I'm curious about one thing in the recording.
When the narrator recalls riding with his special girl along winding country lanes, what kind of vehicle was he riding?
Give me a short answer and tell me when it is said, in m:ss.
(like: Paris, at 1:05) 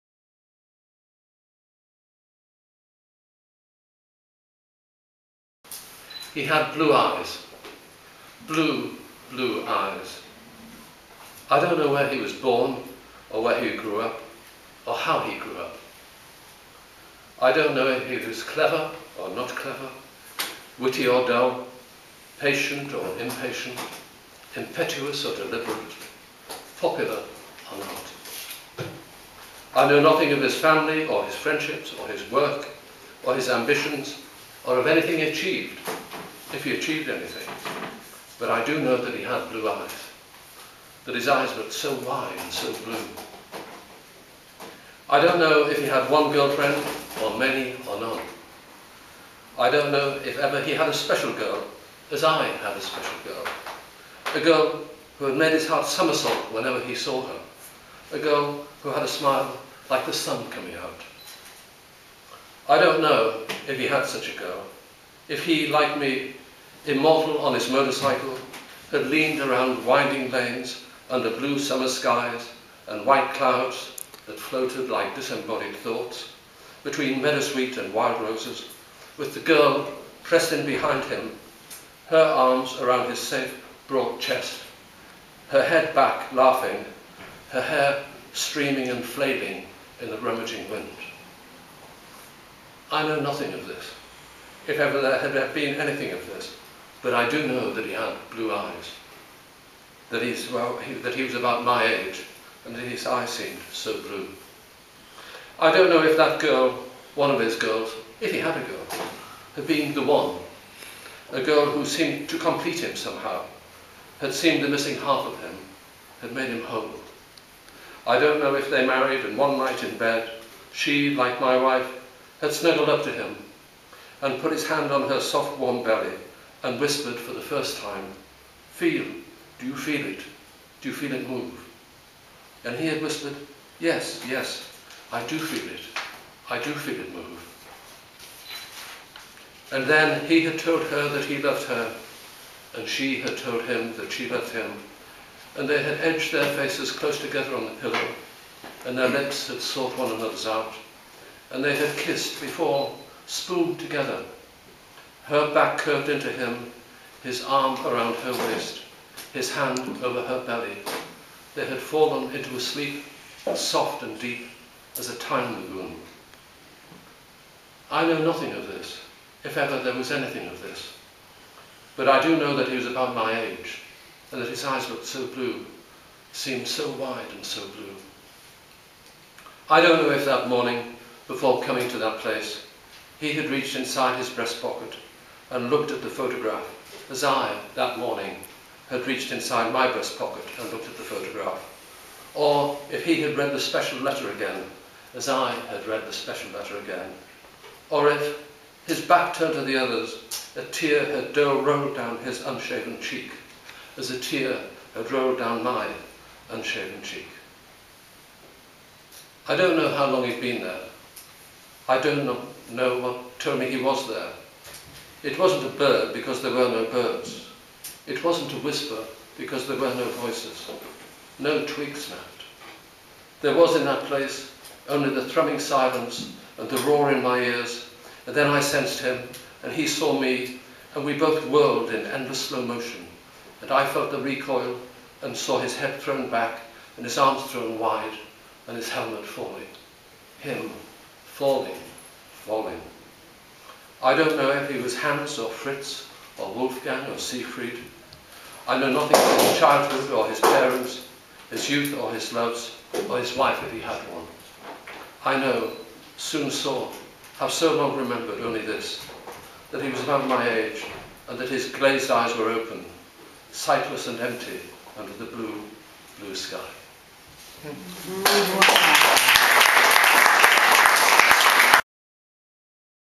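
motorcycle, at 1:07.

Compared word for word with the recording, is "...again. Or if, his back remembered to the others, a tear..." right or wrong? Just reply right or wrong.
wrong.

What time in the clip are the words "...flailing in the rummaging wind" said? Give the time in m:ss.
1:29.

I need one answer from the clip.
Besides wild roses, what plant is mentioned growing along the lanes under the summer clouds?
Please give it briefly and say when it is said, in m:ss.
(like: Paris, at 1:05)
meadowsweet, at 1:17.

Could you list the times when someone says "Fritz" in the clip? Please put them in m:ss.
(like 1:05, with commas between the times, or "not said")
4:05.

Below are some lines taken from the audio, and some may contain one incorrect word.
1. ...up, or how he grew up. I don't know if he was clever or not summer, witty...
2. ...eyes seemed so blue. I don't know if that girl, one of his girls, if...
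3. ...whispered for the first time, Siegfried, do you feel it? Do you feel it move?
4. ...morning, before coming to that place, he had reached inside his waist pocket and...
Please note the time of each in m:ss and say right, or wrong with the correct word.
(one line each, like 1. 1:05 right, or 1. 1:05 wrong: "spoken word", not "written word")
1. 0:13 wrong: "clever", not "summer"
2. 1:43 right
3. 2:06 wrong: "Feel", not "Siegfried"
4. 3:00 wrong: "breast", not "waist".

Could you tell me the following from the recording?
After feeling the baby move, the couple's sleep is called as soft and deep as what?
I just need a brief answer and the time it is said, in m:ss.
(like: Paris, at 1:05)
a time lagoon, at 2:45.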